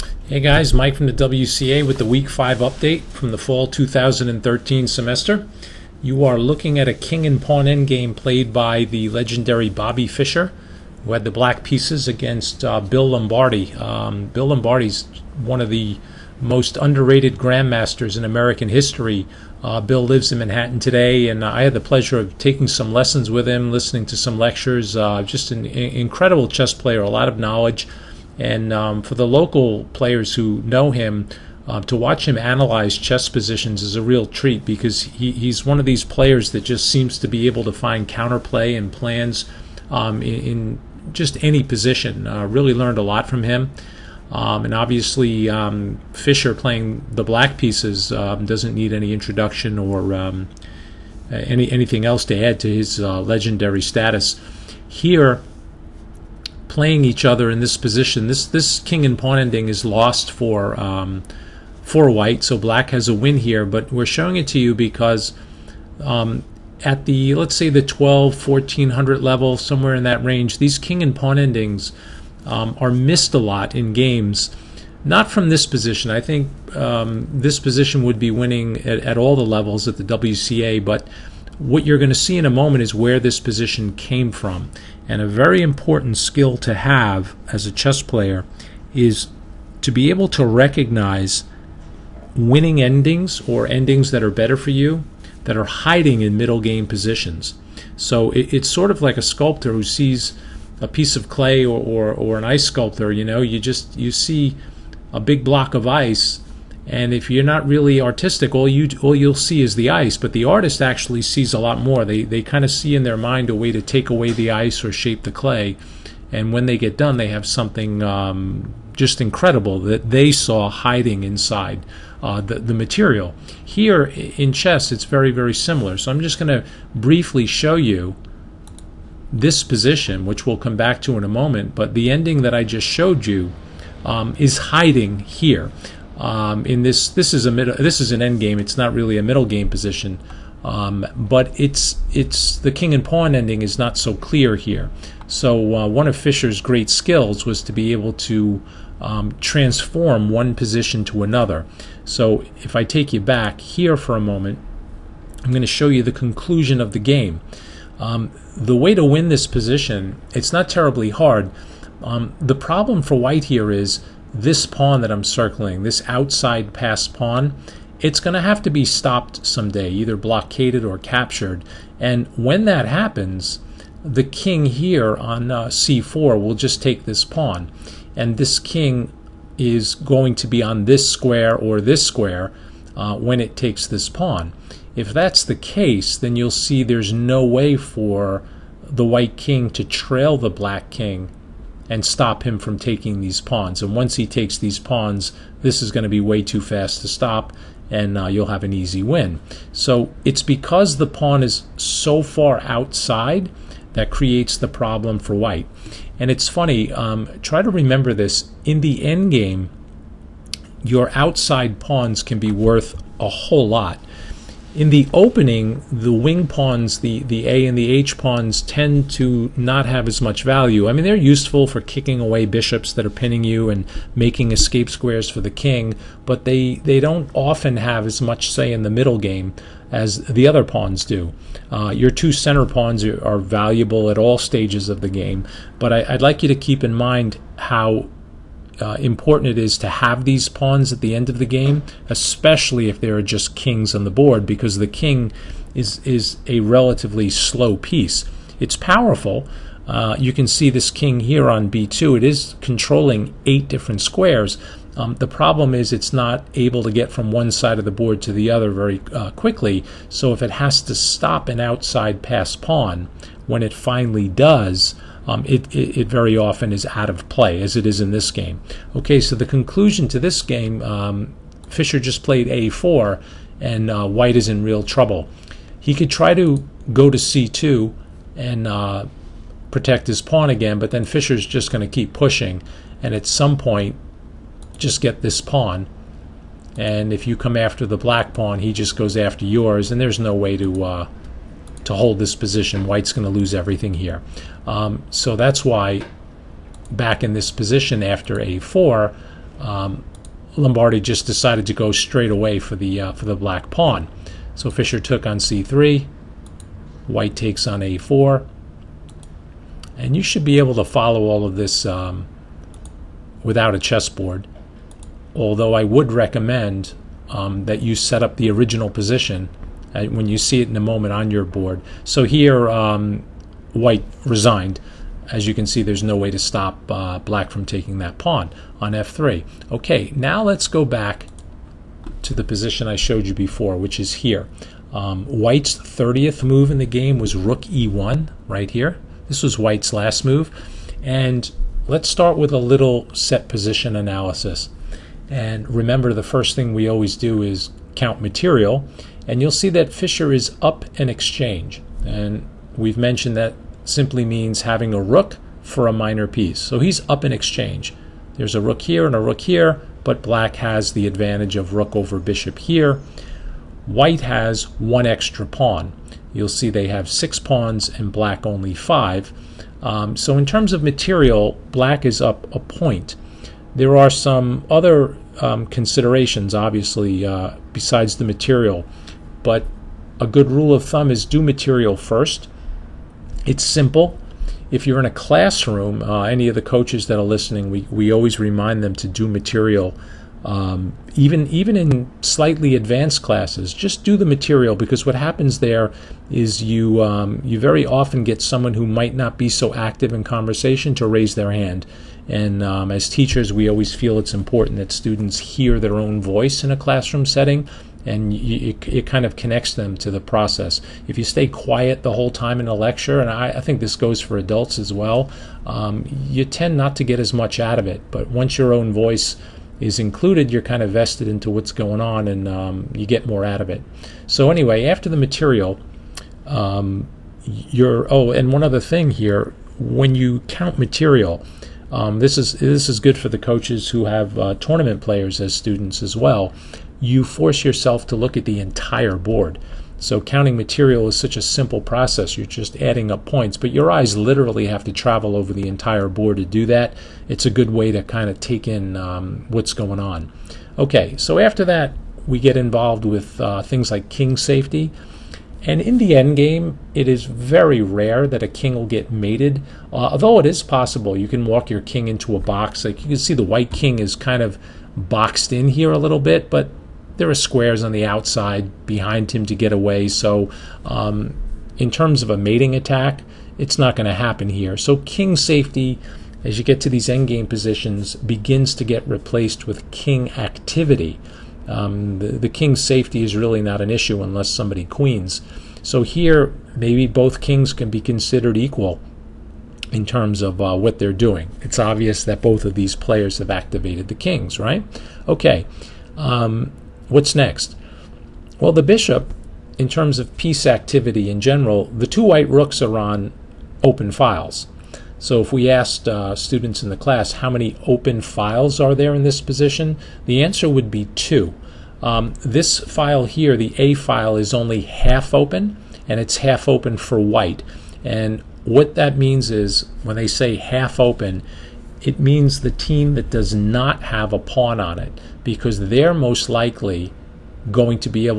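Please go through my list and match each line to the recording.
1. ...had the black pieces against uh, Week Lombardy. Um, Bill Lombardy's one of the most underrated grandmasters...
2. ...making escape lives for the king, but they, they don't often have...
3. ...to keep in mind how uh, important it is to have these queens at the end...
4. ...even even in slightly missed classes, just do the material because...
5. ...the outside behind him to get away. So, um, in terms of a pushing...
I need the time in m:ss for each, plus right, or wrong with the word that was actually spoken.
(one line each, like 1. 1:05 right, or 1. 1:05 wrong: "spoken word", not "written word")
1. 0:11 wrong: "Bill", not "Week"
2. 3:44 wrong: "squares", not "lives"
3. 3:56 wrong: "pawns", not "queens"
4. 6:31 wrong: "advanced", not "missed"
5. 7:47 wrong: "mating", not "pushing".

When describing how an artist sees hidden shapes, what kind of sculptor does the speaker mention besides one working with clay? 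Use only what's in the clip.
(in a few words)
ice sculptor.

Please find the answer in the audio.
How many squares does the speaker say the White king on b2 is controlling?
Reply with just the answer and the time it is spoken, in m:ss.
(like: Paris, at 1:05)
8, at 4:13.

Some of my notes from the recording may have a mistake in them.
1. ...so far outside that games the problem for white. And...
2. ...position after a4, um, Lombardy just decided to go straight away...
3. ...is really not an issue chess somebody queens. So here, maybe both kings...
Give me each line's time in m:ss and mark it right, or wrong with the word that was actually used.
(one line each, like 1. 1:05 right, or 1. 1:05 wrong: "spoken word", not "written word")
1. 3:21 wrong: "creates", not "games"
2. 4:57 right
3. 8:03 wrong: "unless", not "chess".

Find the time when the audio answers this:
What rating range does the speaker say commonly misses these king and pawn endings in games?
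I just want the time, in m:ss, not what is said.
1:07.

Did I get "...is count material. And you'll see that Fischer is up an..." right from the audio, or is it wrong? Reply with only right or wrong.
right.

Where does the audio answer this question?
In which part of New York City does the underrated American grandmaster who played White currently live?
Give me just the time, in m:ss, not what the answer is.
0:20.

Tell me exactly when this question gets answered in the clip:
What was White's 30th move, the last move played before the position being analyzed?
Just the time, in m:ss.
5:37.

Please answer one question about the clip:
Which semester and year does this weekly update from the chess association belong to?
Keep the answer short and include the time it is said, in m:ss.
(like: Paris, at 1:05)
fall 2013, at 0:03.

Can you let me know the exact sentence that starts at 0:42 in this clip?
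Uh, really learned a lot from him.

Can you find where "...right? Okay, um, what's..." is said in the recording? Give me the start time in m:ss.
8:14.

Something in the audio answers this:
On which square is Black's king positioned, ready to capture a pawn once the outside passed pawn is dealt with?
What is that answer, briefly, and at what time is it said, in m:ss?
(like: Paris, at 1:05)
c4, at 2:55.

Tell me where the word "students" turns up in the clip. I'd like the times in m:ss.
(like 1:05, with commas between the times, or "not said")
6:44, 7:15, 8:26.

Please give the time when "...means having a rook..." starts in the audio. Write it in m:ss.
5:54.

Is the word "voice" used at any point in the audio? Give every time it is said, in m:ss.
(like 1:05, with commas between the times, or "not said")
6:46, 6:58.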